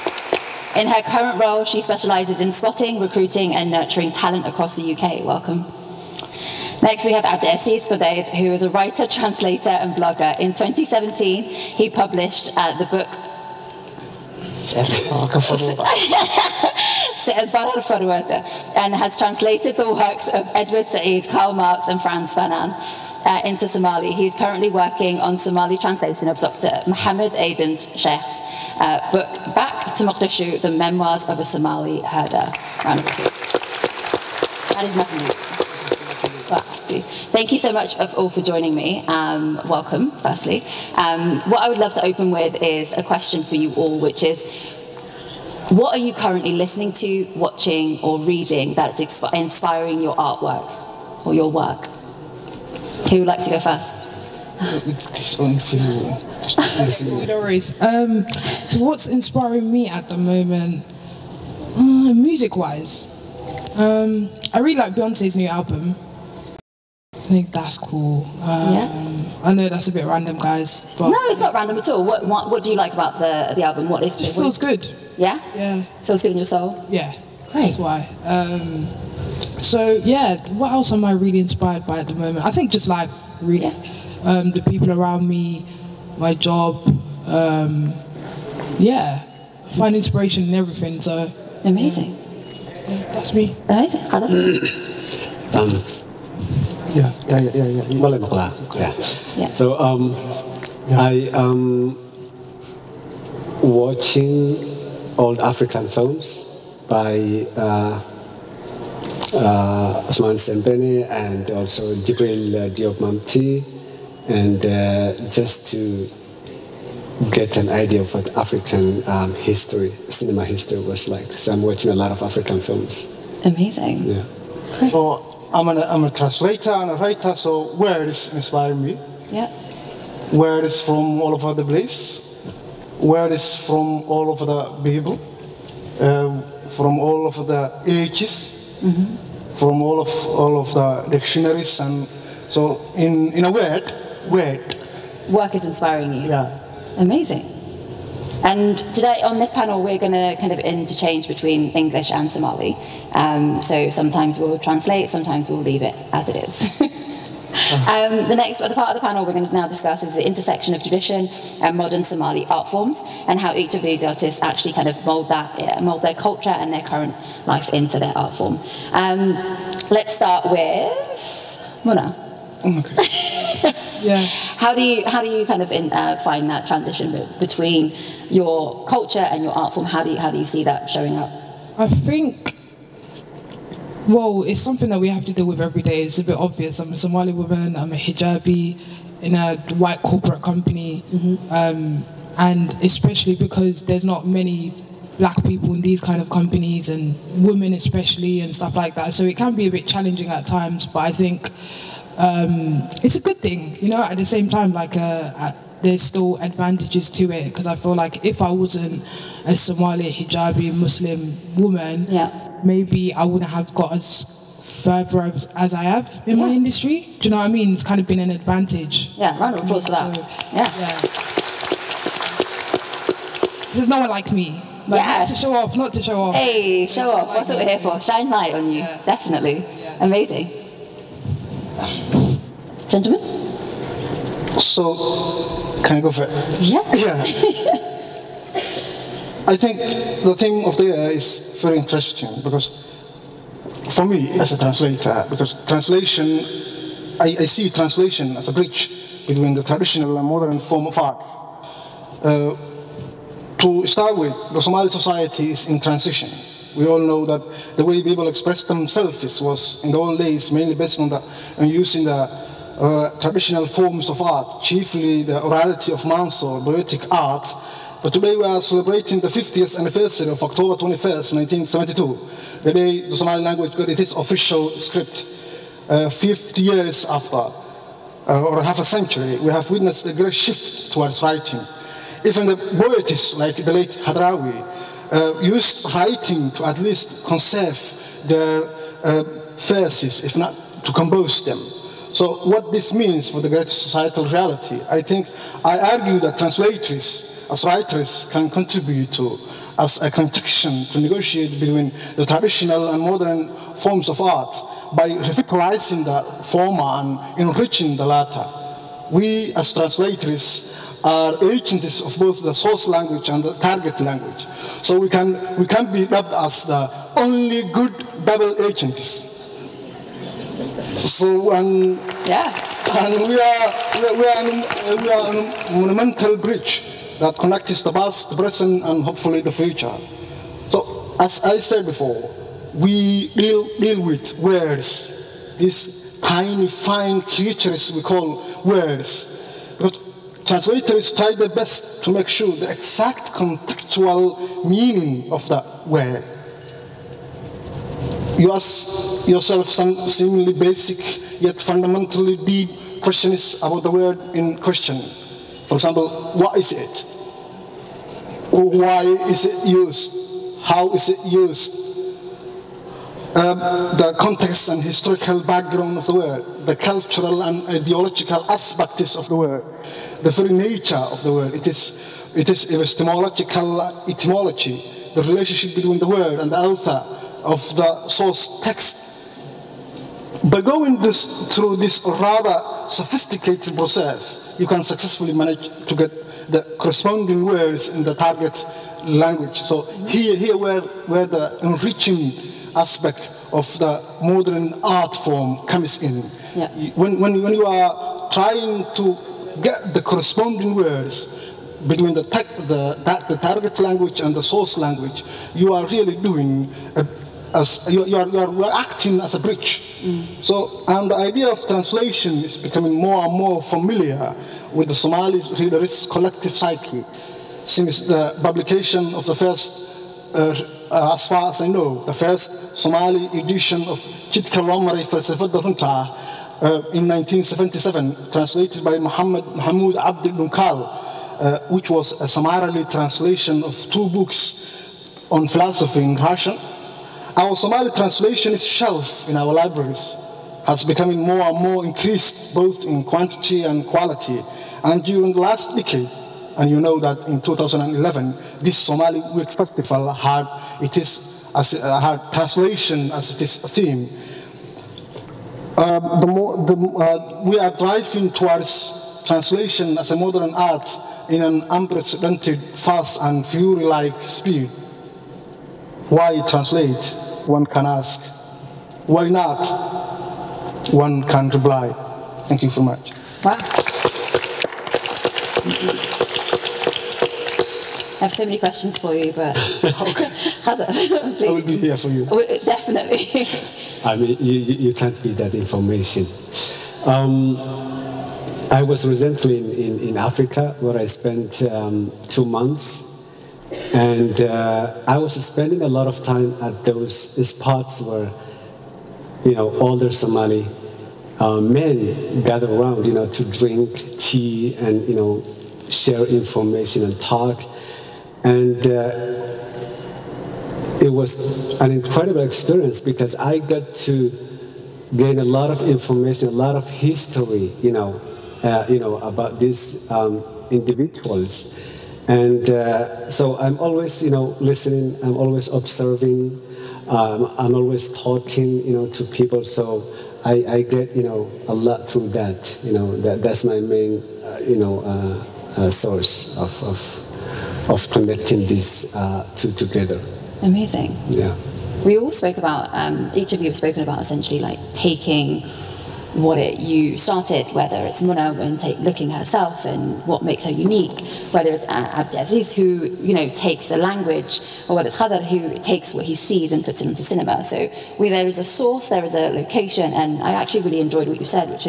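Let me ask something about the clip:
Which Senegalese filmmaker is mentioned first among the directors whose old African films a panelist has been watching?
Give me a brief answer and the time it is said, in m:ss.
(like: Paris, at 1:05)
Ousmane Sembene, at 1:50.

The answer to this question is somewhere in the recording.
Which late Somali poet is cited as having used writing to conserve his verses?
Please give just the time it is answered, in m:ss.
4:44.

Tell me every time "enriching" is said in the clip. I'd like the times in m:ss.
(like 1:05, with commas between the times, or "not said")
5:07, 6:31.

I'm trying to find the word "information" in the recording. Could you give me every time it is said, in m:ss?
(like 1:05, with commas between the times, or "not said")
8:05, 8:26, 8:35.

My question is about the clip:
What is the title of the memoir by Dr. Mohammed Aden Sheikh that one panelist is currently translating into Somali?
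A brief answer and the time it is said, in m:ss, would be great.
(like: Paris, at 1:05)
Back to Mogadishu, at 0:29.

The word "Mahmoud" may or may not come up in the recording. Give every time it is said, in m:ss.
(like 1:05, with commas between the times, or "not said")
7:09.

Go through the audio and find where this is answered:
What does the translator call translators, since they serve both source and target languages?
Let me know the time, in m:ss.
5:18.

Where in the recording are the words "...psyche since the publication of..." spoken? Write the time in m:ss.
6:56.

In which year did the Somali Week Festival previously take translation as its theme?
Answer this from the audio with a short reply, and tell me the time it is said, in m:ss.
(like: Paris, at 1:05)
2011, at 7:27.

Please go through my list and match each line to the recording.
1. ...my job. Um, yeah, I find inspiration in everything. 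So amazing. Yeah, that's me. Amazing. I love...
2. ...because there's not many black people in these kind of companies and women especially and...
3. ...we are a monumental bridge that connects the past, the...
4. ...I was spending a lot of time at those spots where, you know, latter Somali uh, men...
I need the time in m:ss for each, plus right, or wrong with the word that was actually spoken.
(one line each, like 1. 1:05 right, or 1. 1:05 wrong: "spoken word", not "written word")
1. 1:26 right
2. 3:13 right
3. 5:25 right
4. 8:15 wrong: "older", not "latter".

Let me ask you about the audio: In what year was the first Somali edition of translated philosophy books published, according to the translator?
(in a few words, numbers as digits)
1977.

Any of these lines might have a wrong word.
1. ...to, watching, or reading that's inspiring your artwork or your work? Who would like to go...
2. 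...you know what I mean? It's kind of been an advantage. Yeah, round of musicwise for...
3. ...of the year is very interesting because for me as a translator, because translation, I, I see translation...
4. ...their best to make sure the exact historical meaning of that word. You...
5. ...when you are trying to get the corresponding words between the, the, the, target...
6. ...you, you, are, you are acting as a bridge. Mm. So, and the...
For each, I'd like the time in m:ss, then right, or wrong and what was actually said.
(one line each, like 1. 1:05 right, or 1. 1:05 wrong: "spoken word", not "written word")
1. 0:46 right
2. 3:37 wrong: "applause", not "musicwise"
3. 4:00 right
4. 5:41 wrong: "contextual", not "historical"
5. 6:37 right
6. 6:47 right.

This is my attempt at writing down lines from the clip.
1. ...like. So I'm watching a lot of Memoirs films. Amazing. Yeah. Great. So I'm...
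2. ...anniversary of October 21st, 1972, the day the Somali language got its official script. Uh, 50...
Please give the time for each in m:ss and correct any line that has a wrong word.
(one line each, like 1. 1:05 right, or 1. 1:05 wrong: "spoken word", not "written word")
1. 2:01 wrong: "African", not "Memoirs"
2. 4:29 right.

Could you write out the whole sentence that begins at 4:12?
Uh, to start with, the Somali society is in transition.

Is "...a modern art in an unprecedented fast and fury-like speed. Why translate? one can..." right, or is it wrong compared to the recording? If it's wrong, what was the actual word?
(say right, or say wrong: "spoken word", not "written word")
right.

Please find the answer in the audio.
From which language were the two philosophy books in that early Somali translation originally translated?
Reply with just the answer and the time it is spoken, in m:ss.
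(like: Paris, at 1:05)
Russian, at 7:16.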